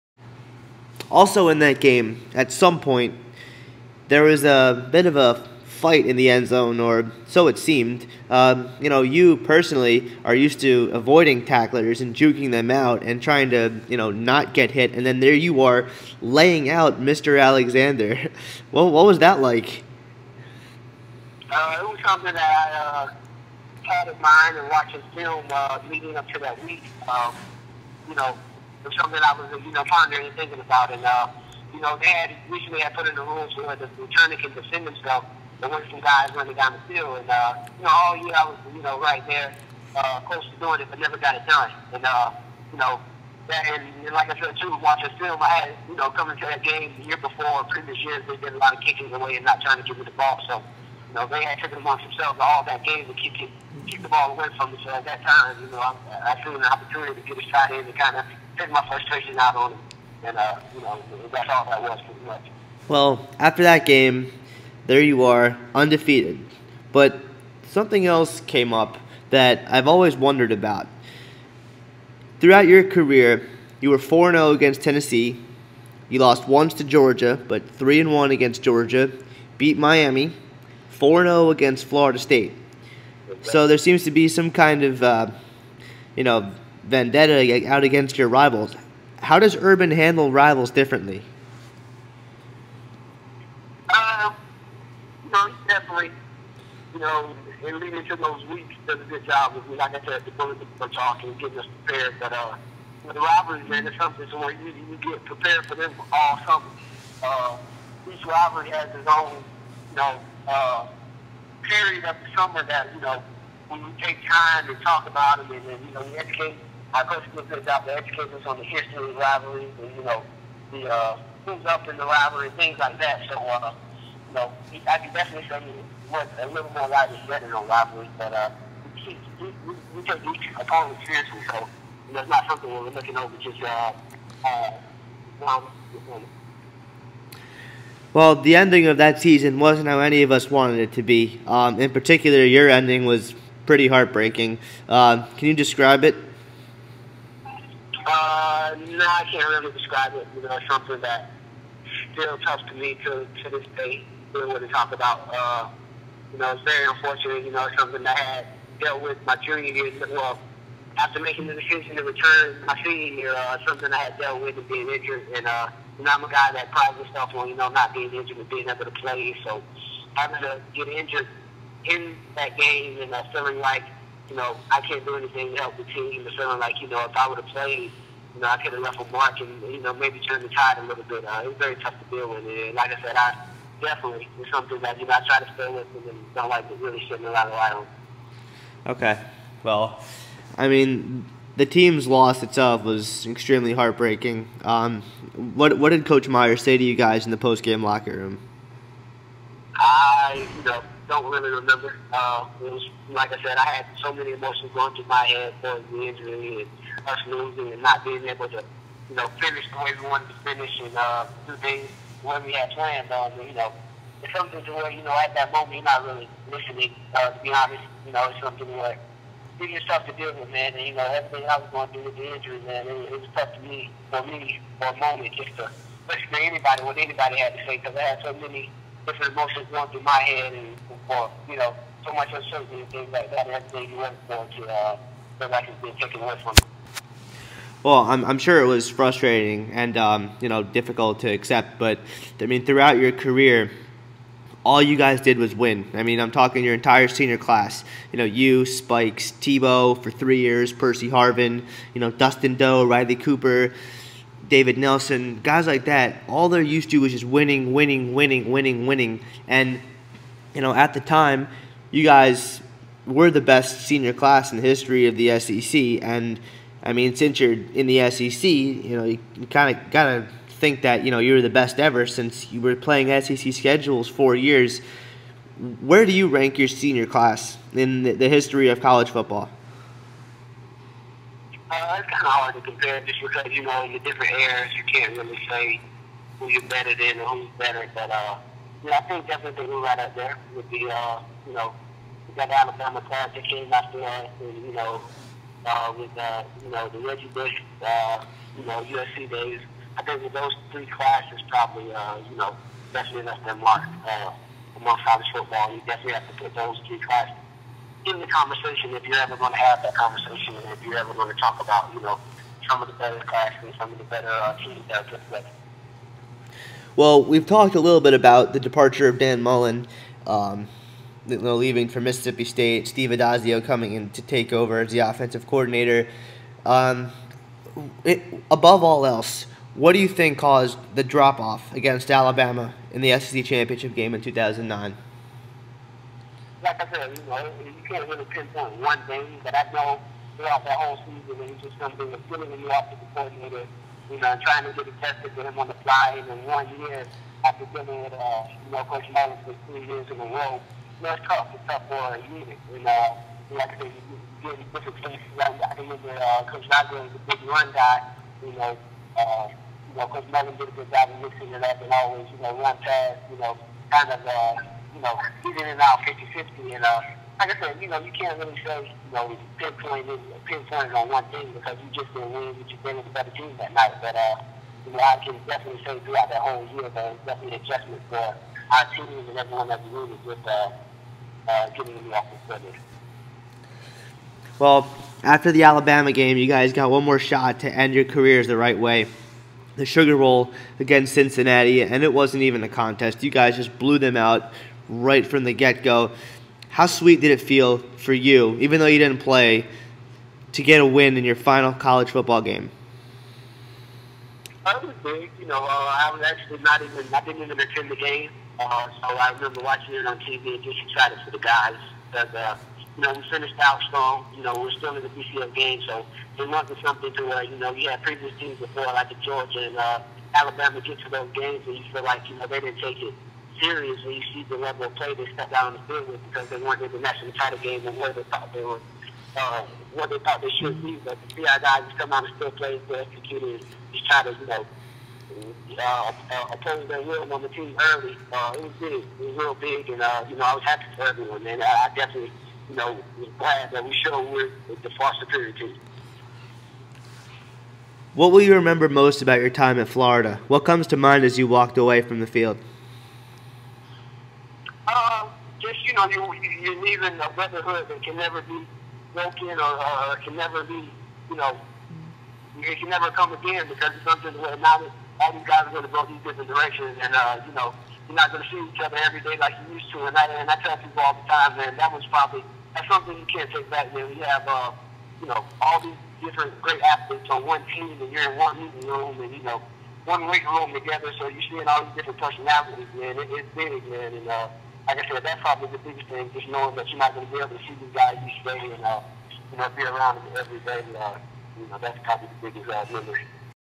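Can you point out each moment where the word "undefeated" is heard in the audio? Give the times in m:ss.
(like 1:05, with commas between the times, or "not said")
1:05.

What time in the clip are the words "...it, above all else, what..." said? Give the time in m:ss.
5:28.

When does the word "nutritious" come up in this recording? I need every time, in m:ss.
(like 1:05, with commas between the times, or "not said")
not said.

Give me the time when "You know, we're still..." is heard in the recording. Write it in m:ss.
6:54.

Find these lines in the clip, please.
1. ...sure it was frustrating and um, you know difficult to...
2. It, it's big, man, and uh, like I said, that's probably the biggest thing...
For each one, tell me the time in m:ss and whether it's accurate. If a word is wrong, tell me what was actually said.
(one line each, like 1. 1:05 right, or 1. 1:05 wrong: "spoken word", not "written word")
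1. 3:58 right
2. 8:03 right.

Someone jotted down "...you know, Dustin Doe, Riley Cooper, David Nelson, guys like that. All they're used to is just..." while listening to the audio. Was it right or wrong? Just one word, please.
right.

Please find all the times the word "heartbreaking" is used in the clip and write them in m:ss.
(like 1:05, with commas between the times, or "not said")
2:23, 3:13.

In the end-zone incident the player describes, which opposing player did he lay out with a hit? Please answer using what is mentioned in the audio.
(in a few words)
Alexander.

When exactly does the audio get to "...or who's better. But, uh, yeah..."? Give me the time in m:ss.
4:47.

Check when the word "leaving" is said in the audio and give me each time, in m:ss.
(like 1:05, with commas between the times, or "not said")
5:21, 7:36.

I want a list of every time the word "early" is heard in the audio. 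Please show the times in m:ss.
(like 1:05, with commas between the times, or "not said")
7:17.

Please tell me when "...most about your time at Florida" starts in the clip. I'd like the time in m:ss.
7:28.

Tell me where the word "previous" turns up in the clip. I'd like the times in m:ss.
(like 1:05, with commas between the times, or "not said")
0:47, 6:58.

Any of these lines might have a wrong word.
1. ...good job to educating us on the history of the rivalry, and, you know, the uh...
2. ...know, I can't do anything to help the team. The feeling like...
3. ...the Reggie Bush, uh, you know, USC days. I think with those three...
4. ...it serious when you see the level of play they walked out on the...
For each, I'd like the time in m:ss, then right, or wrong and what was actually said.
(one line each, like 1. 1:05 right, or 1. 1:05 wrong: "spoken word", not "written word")
1. 1:57 right
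2. 2:54 right
3. 4:56 right
4. 7:03 wrong: "stepped", not "walked".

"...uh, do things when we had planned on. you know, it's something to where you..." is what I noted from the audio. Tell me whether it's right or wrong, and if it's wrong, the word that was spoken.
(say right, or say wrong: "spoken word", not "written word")
right.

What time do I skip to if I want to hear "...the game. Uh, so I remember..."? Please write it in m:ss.
6:47.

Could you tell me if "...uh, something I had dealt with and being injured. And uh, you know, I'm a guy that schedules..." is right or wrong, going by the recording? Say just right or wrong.
wrong.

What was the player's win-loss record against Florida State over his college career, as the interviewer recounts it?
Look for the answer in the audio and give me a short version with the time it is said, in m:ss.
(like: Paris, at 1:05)
4-0, at 1:20.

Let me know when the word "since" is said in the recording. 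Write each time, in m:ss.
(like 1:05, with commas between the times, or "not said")
4:27, 4:32.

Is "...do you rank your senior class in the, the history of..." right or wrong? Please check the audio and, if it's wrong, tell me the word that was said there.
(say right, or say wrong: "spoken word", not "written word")
right.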